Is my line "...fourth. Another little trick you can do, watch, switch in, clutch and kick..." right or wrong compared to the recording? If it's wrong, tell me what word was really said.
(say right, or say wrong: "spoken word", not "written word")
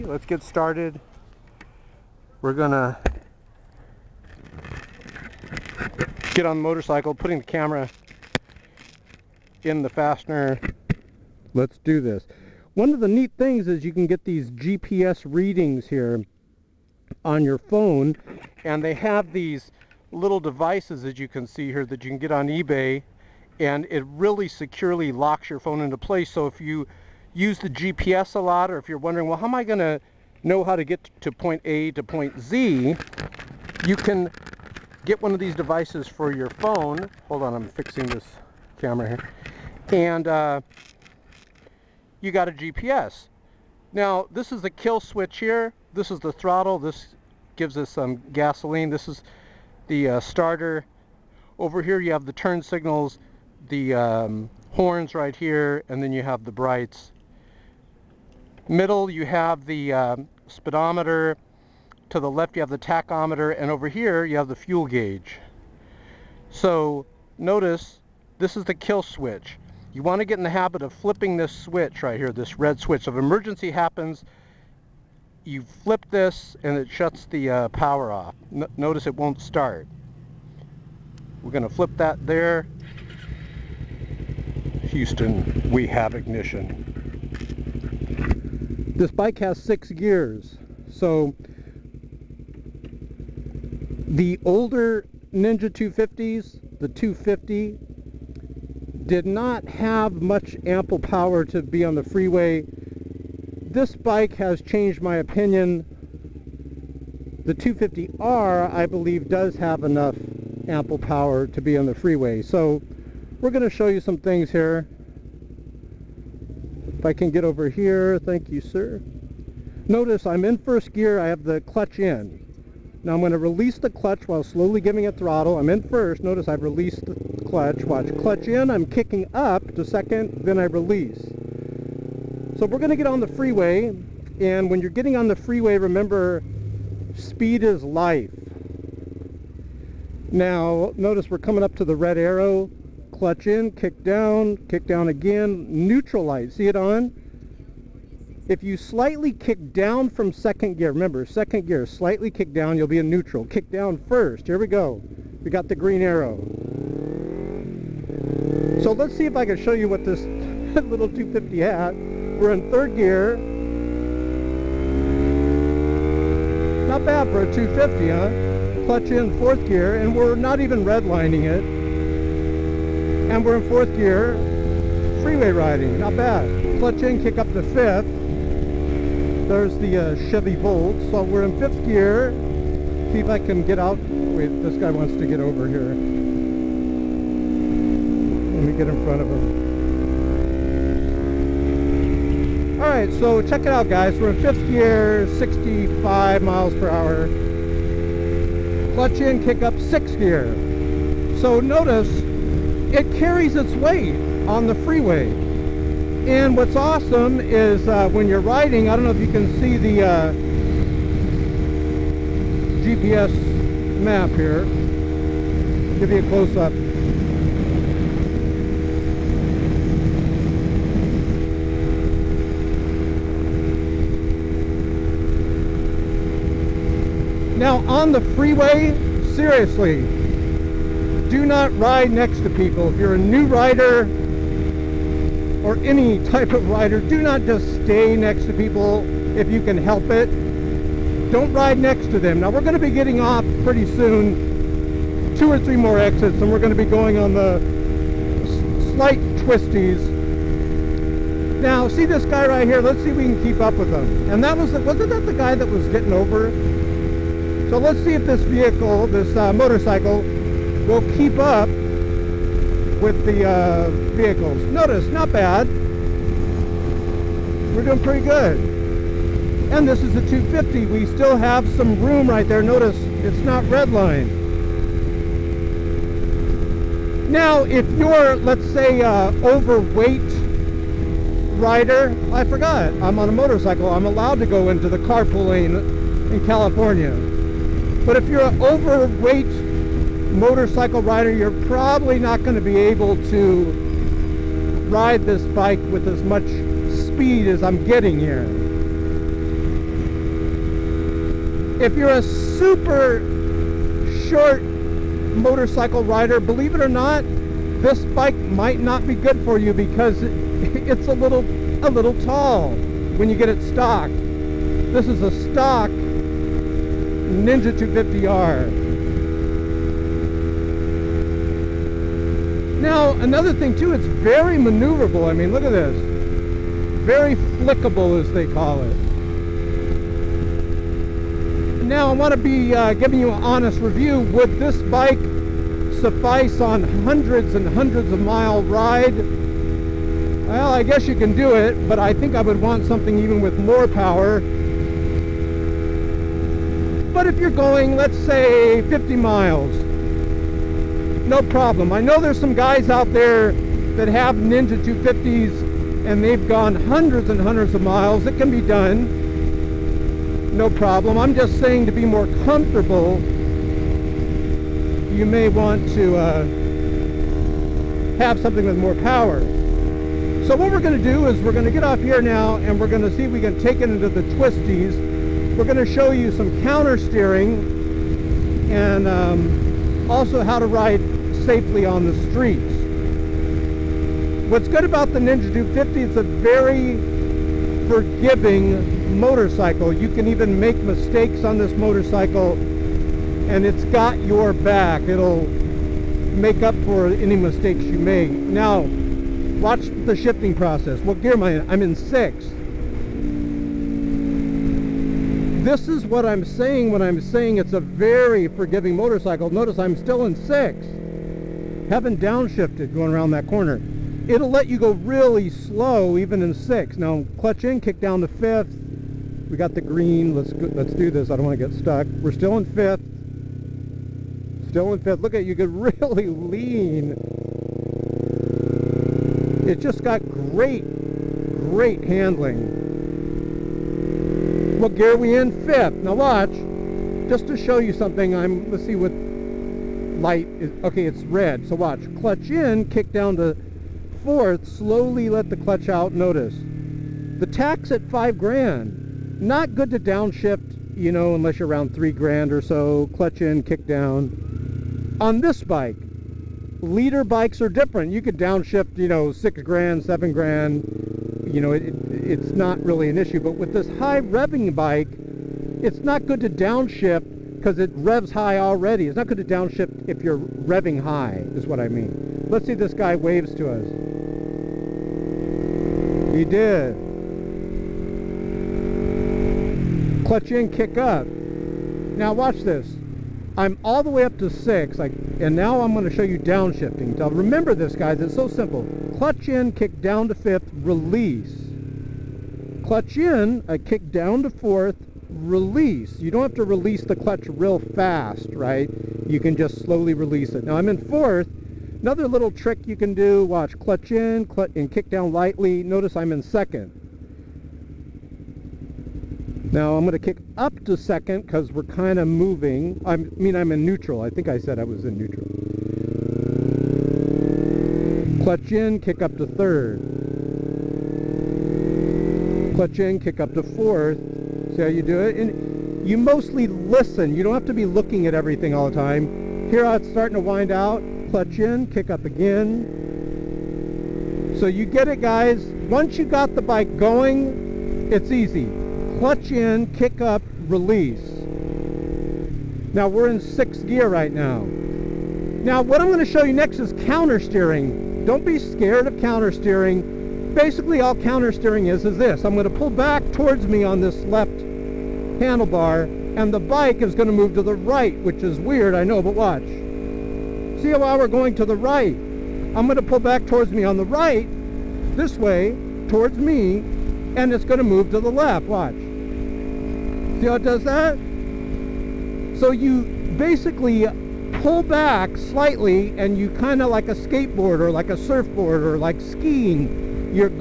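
wrong: "clutch", not "switch".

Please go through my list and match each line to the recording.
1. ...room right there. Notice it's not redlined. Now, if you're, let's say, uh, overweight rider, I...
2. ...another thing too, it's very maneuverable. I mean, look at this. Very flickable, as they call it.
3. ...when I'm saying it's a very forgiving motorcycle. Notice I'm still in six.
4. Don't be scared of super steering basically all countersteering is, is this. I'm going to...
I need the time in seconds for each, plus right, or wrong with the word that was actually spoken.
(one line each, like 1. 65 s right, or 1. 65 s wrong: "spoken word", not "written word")
1. 272 s right
2. 323 s right
3. 406 s right
4. 548 s wrong: "counter", not "super".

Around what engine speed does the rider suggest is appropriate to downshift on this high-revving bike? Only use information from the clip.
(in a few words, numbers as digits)
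3,000.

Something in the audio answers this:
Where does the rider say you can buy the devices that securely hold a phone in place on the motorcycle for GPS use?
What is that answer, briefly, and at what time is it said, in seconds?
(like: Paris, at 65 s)
eBay, at 22 s.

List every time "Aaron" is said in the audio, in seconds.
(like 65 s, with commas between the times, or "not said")
not said.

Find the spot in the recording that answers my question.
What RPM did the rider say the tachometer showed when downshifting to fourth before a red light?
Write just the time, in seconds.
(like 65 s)
448 s.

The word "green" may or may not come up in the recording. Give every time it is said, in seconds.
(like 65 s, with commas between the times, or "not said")
155 s, 419 s.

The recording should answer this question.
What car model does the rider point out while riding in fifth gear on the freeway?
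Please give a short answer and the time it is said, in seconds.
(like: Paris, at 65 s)
Chevy Volt, at 180 s.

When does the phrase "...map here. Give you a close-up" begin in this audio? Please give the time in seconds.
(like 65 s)
214 s.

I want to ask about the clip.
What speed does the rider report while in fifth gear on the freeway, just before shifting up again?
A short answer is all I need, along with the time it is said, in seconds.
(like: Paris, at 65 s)
65 miles per hour, at 195 s.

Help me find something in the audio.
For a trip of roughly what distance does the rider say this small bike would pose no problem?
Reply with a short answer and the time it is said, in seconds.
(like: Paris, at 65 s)
50 miles, at 348 s.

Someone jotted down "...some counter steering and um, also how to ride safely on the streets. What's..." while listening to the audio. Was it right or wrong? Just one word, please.
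right.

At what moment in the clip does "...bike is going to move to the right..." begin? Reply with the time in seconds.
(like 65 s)
556 s.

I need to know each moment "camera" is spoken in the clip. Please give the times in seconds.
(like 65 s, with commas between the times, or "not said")
7 s, 38 s.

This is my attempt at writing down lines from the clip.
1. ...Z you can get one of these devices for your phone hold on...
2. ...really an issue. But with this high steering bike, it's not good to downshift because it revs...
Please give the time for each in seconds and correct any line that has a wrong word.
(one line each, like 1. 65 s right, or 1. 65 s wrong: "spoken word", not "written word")
1. 32 s right
2. 462 s wrong: "revving", not "steering".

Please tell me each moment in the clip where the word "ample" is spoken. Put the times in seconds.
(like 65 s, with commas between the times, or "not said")
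100 s, 110 s.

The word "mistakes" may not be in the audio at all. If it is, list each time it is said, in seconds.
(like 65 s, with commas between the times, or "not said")
390 s, 397 s.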